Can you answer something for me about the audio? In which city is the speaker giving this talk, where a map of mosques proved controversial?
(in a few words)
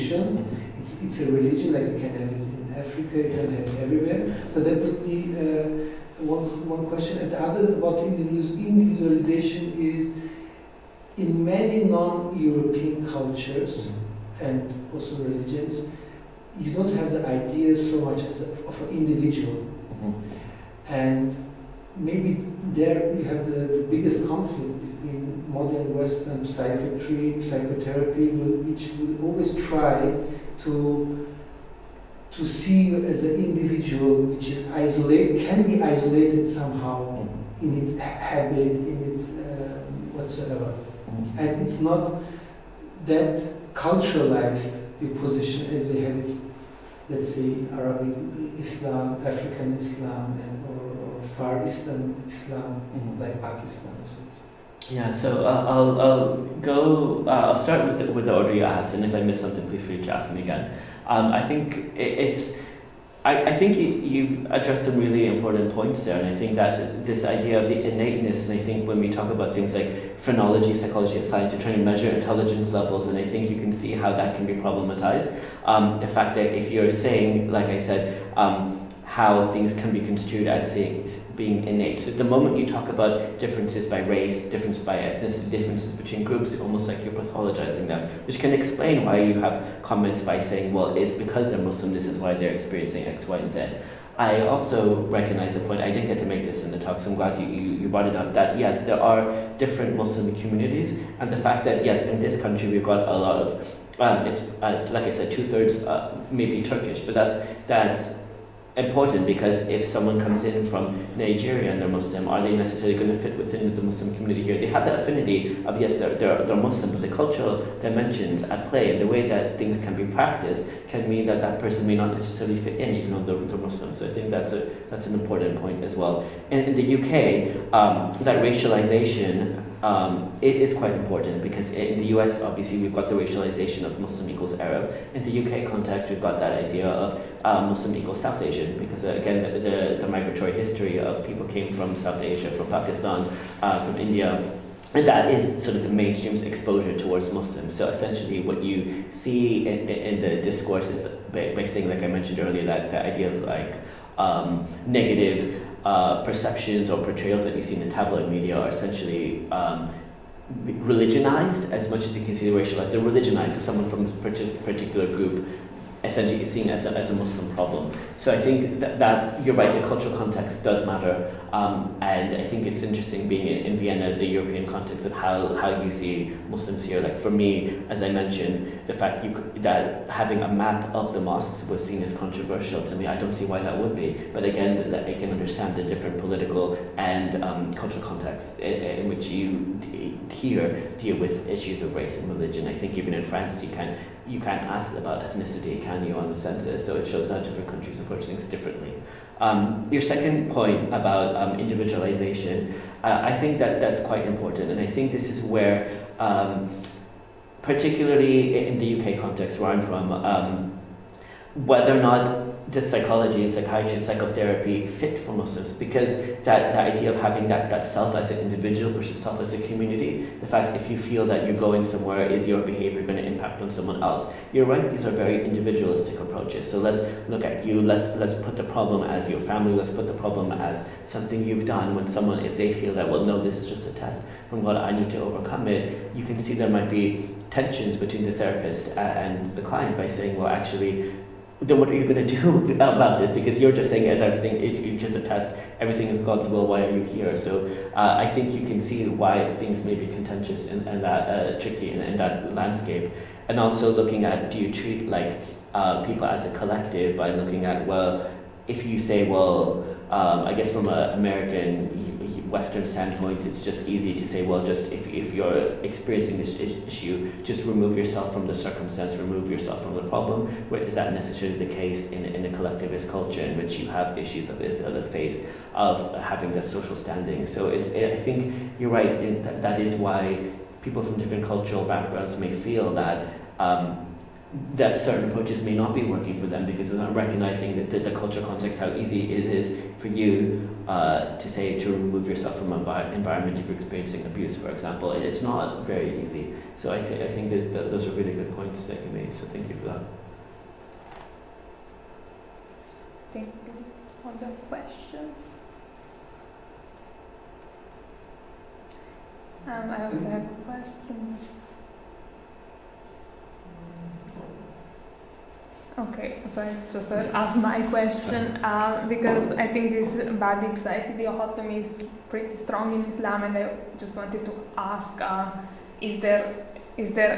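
Vienna.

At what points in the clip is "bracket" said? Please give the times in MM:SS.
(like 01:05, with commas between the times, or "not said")
not said.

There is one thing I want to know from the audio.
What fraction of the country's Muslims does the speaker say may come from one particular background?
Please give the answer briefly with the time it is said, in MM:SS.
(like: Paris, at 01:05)
two-thirds, at 01:45.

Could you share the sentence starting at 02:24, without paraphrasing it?
And that is sort of the mainstream's exposure towards Muslims.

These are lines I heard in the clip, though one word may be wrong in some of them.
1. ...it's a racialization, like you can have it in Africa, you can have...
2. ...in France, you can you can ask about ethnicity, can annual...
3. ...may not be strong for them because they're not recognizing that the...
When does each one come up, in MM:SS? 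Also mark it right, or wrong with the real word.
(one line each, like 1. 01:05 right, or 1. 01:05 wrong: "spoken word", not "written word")
1. 00:01 wrong: "religion", not "racialization"
2. 03:13 right
3. 04:45 wrong: "working", not "strong".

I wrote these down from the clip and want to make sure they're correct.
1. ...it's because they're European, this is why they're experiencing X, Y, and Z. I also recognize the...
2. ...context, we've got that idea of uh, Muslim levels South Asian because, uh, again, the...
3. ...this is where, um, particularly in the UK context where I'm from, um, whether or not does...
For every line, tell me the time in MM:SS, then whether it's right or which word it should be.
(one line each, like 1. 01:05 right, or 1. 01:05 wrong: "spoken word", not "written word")
1. 01:30 wrong: "Muslim", not "European"
2. 02:15 wrong: "equals", not "levels"
3. 03:25 right.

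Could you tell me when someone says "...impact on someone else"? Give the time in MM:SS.
03:43.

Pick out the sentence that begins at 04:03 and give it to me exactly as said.
Because you're just saying, as everything is just a test, everything is God's will, why are you here?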